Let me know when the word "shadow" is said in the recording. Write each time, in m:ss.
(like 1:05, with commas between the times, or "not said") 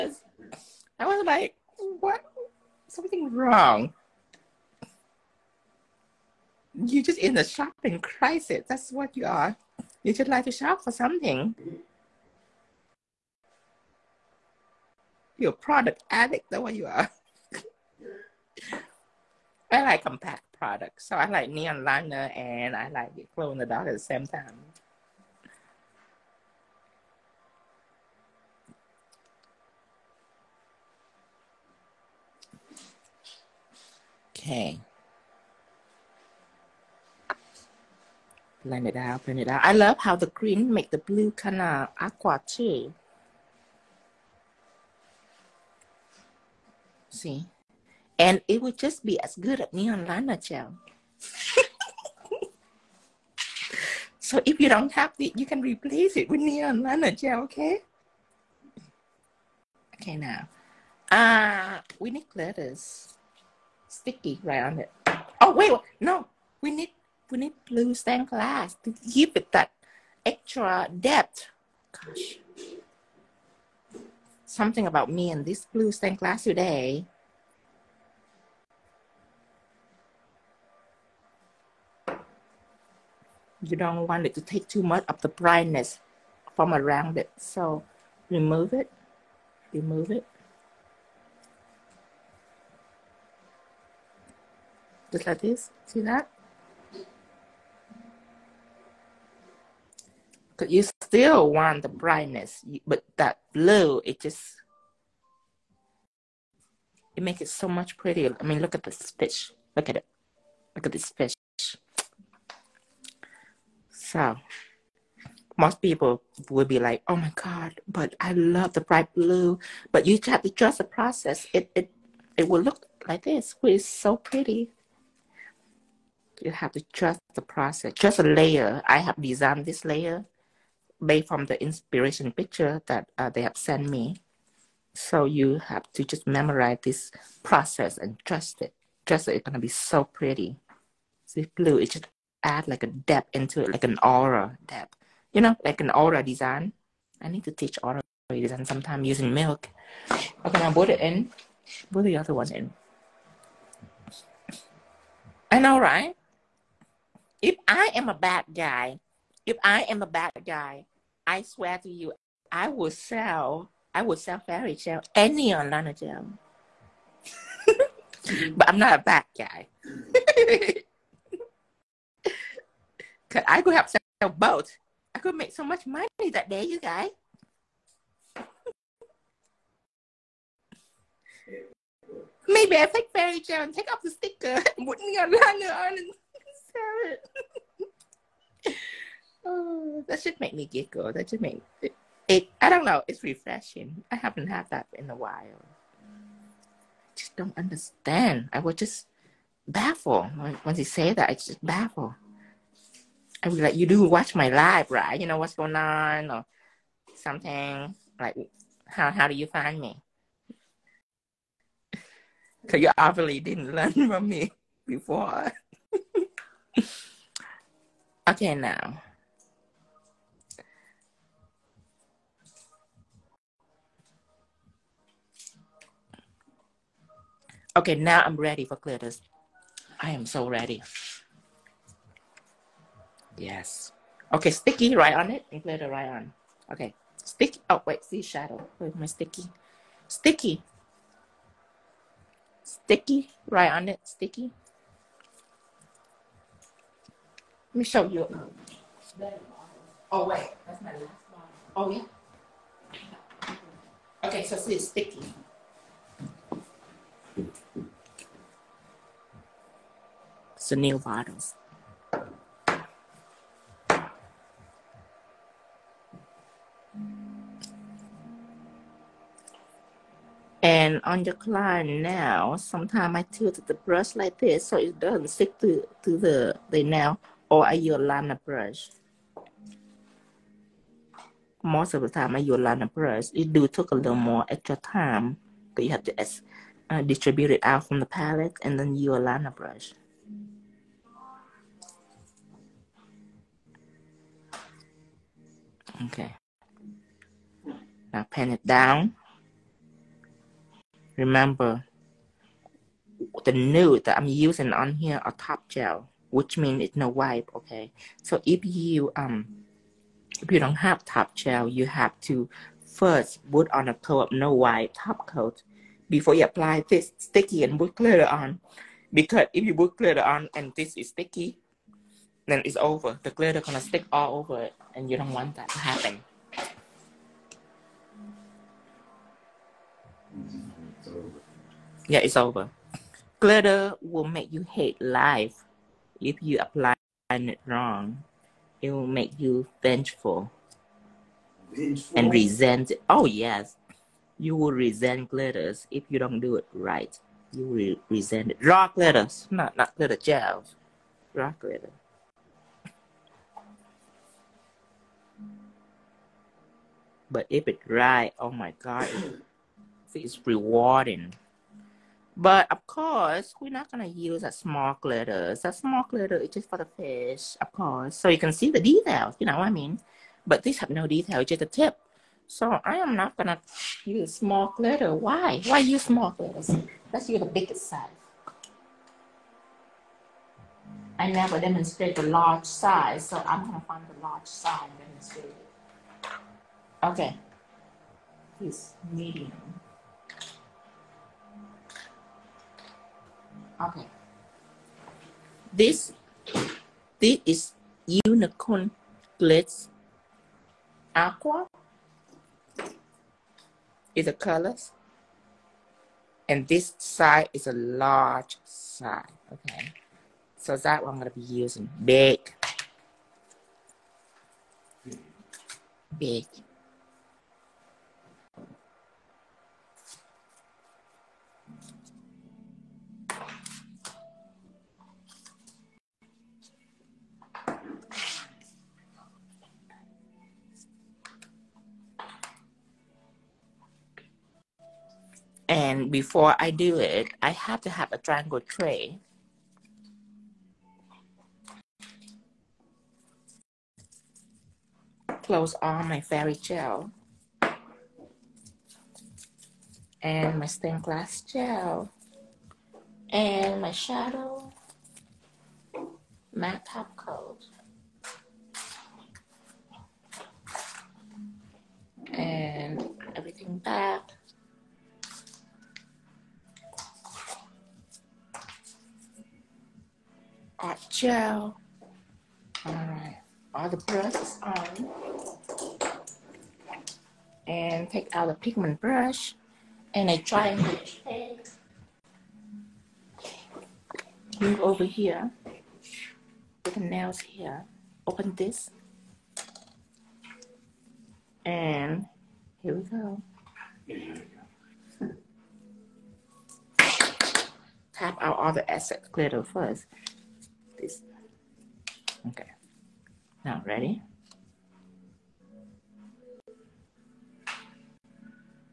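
3:58, 7:33.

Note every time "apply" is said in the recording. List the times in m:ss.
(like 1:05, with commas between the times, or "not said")
5:16, 5:36.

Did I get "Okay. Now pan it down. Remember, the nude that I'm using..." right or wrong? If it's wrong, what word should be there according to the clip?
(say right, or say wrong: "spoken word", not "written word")
right.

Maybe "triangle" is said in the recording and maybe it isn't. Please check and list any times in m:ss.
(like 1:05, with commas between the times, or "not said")
7:18, 8:00.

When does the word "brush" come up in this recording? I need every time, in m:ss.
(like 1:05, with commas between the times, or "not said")
4:33, 4:38, 4:42, 4:49, 7:53, 7:59.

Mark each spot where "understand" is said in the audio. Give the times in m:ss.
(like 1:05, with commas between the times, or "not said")
3:17.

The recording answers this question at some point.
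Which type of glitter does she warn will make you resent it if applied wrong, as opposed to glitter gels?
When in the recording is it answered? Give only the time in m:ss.
5:51.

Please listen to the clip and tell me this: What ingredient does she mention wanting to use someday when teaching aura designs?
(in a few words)
milk.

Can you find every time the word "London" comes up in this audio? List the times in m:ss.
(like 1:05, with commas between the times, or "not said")
not said.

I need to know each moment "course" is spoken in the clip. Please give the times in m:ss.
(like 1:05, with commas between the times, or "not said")
6:02, 6:07.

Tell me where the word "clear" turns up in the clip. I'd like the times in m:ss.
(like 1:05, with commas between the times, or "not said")
3:48.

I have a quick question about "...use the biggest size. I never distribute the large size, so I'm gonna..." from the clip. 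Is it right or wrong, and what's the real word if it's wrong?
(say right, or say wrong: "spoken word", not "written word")
wrong: "demonstrate", not "distribute".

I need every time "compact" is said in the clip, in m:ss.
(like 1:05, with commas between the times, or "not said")
0:20.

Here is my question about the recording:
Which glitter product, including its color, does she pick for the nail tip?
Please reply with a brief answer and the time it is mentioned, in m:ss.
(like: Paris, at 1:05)
unicorn glitz aqua, at 6:38.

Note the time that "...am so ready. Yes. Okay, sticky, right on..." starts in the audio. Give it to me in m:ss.
3:50.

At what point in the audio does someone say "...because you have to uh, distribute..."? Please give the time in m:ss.
4:45.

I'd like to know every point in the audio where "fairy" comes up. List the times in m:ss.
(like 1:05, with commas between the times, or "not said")
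2:44, 3:03, 7:26.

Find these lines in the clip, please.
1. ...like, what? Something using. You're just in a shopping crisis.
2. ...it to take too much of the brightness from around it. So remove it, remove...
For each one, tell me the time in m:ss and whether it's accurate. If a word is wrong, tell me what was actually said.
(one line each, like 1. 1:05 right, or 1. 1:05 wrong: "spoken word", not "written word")
1. 0:01 wrong: "wrong", not "using"
2. 1:24 right.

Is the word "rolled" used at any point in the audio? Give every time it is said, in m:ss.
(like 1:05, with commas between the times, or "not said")
not said.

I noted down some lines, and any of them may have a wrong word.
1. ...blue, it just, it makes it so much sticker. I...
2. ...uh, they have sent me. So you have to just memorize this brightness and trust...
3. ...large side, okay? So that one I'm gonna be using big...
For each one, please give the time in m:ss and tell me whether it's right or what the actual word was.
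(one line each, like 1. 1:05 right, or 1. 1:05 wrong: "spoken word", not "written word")
1. 1:43 wrong: "prettier", not "sticker"
2. 2:13 wrong: "process", not "brightness"
3. 6:47 right.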